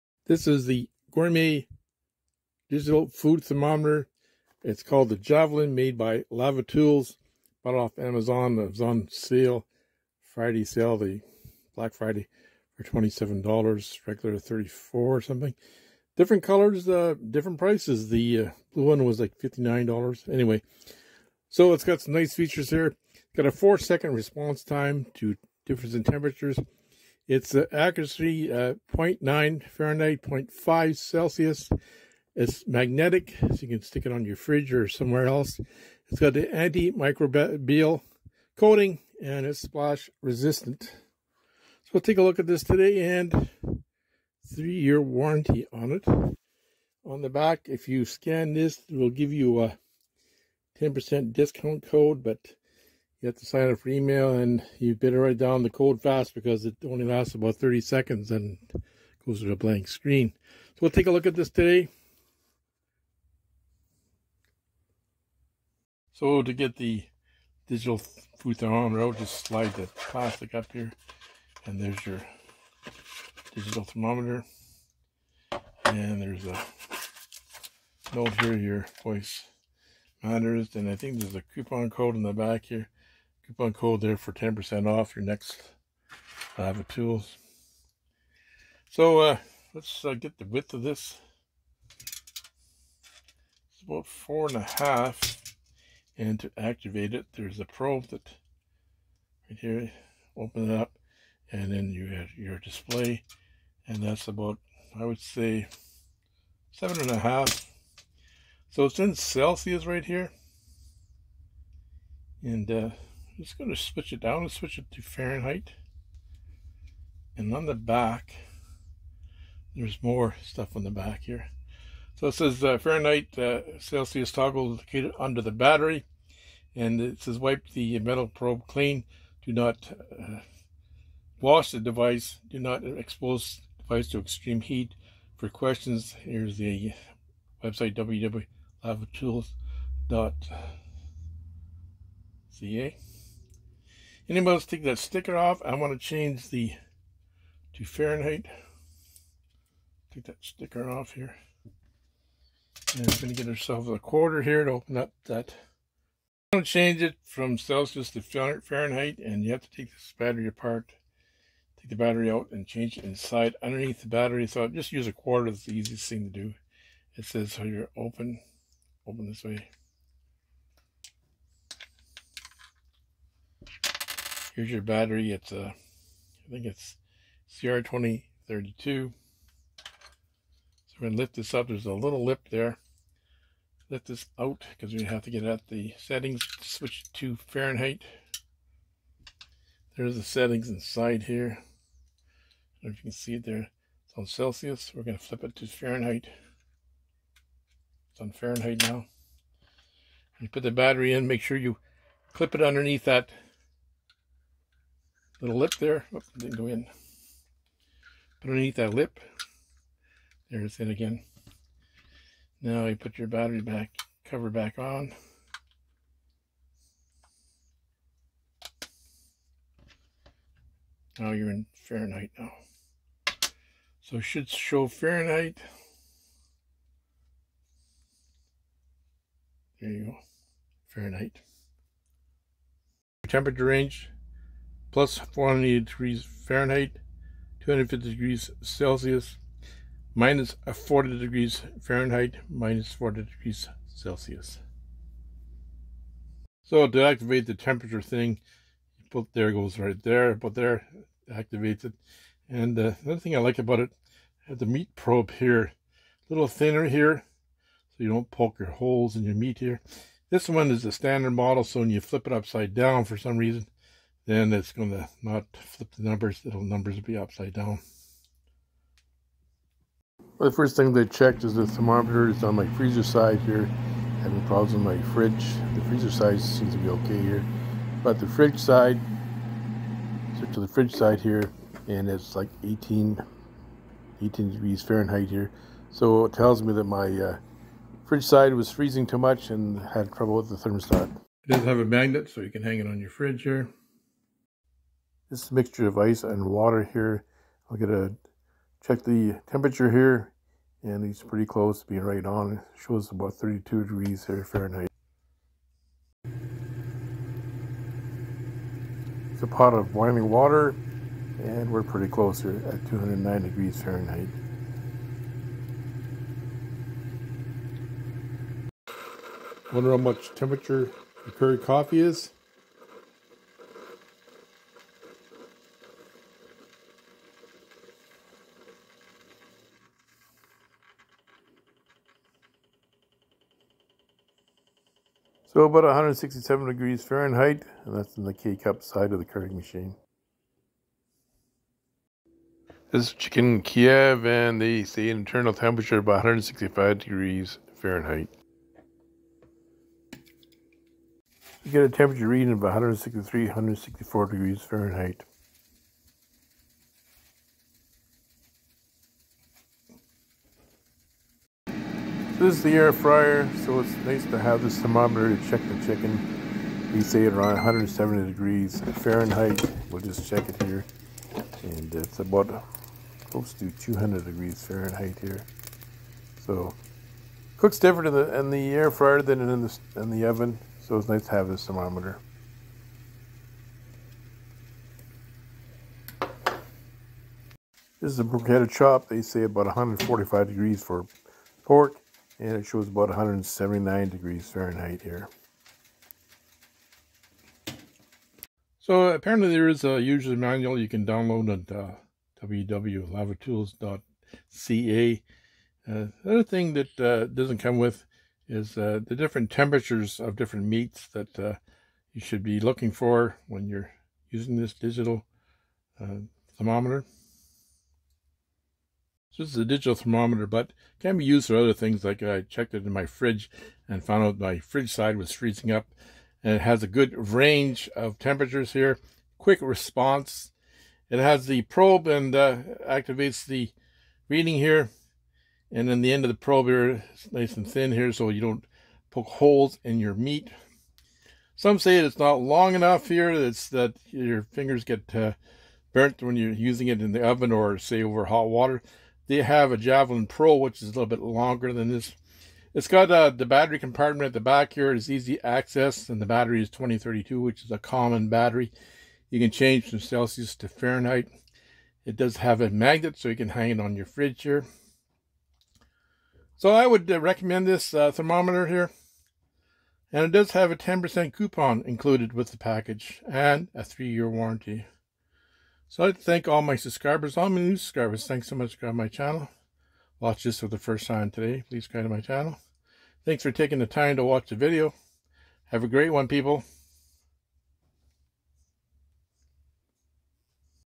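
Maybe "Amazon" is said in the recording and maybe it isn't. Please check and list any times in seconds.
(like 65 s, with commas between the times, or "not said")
7 s.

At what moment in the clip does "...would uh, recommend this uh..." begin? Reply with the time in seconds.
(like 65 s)
466 s.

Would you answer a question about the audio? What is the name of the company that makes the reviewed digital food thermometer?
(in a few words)
LavaTools.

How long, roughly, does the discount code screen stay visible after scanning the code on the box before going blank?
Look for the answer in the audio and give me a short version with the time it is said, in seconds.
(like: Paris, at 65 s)
30 seconds, at 57 s.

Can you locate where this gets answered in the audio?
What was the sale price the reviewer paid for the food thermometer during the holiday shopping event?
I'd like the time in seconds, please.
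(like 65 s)
12 s.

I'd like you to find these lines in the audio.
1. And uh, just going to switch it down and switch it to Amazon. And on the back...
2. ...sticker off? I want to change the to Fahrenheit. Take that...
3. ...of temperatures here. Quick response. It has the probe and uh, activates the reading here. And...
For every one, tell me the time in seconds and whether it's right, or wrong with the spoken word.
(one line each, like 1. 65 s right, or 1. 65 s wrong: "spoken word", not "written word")
1. 112 s wrong: "Fahrenheit", not "Amazon"
2. 144 s right
3. 427 s right.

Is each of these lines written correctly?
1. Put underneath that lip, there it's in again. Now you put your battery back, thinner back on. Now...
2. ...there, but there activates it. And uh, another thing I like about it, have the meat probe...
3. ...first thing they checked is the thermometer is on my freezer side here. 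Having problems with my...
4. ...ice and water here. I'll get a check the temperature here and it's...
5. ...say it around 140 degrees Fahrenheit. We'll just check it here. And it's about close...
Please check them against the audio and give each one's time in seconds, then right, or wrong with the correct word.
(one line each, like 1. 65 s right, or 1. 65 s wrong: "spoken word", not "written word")
1. 208 s wrong: "cover", not "thinner"
2. 250 s right
3. 270 s right
4. 295 s right
5. 367 s wrong: "170", not "140".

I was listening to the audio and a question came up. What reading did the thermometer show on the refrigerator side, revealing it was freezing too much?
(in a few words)
18°F.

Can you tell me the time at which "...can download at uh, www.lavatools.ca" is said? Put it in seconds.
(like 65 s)
400 s.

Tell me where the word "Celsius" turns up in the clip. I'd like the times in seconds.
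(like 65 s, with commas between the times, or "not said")
30 s, 109 s, 123 s, 157 s, 194 s, 238 s, 243 s, 459 s.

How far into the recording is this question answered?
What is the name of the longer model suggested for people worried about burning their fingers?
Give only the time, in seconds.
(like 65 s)
449 s.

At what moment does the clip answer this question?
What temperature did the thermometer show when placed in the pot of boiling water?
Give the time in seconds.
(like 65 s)
312 s.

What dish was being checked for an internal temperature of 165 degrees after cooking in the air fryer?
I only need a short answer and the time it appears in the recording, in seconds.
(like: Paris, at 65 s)
Chicken Kiev, at 343 s.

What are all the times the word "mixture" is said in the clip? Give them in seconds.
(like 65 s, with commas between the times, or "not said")
295 s.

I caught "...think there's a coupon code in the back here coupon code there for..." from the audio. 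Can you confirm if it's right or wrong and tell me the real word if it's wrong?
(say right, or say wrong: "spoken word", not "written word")
right.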